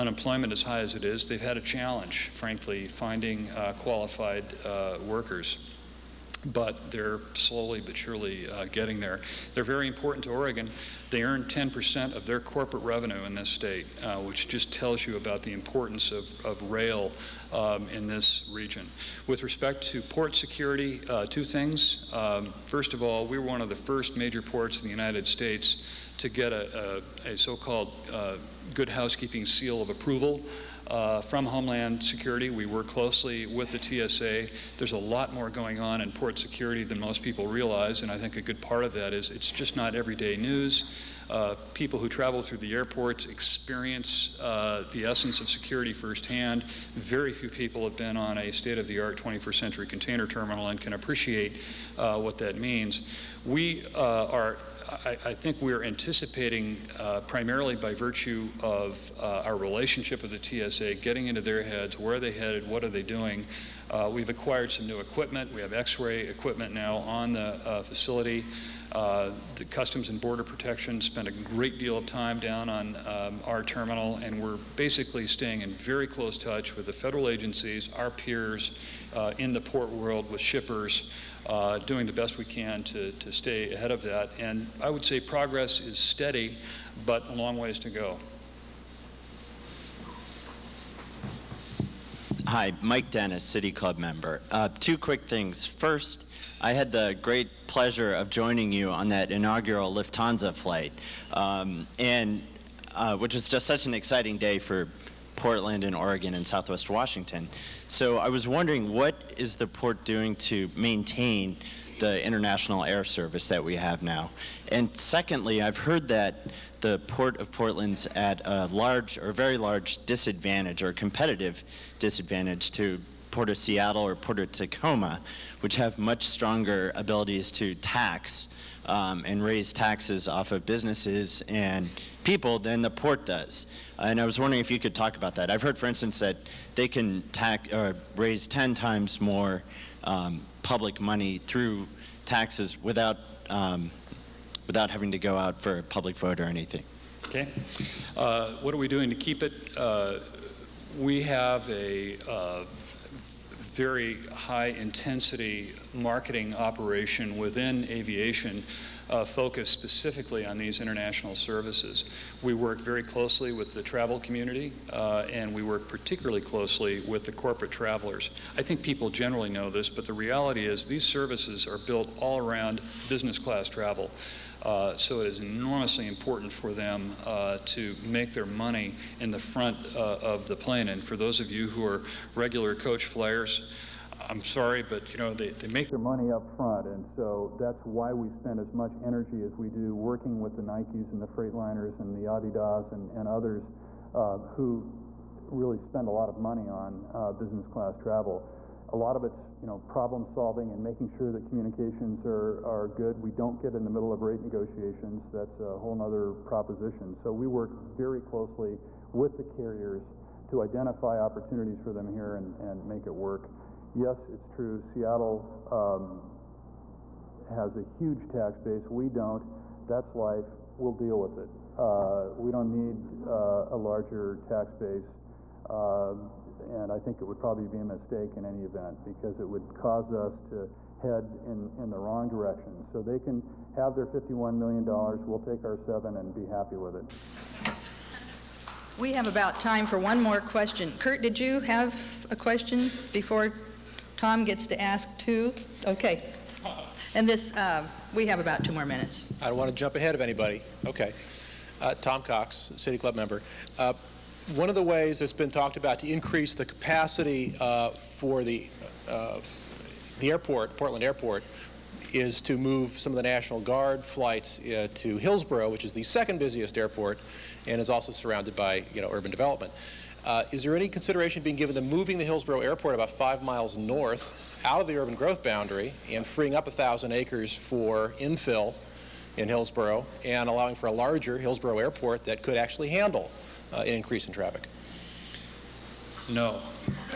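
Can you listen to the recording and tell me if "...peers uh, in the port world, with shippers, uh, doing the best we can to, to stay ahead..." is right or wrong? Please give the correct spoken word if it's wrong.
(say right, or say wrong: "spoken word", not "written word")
right.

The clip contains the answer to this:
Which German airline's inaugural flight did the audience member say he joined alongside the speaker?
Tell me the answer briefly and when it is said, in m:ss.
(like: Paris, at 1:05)
Lufthansa, at 1:39.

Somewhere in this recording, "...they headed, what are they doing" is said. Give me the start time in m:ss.
1:02.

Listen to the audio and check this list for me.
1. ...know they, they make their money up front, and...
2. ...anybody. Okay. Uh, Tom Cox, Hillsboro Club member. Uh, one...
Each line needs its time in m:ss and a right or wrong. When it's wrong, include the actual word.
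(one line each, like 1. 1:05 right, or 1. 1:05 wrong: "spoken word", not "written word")
1. 3:05 right
2. 4:10 wrong: "City", not "Hillsboro".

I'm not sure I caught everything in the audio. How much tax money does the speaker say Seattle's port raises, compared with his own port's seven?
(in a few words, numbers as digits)
$51 million.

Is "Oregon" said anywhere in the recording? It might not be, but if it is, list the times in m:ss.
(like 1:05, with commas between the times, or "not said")
0:10, 1:45.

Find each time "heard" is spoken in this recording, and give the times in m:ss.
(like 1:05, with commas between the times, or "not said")
1:55, 2:15.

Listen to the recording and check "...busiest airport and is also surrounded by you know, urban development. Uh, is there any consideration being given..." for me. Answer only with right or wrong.
right.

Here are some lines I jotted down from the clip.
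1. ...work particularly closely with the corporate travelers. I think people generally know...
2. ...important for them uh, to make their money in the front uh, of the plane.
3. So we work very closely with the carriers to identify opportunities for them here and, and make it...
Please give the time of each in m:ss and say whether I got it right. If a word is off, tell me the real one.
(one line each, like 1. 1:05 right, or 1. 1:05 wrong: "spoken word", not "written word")
1. 2:45 right
2. 2:56 right
3. 3:27 right.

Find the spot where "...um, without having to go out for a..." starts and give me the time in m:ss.
2:23.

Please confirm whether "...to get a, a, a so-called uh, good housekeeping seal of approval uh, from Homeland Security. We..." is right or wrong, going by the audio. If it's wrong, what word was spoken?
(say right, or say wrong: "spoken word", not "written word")
right.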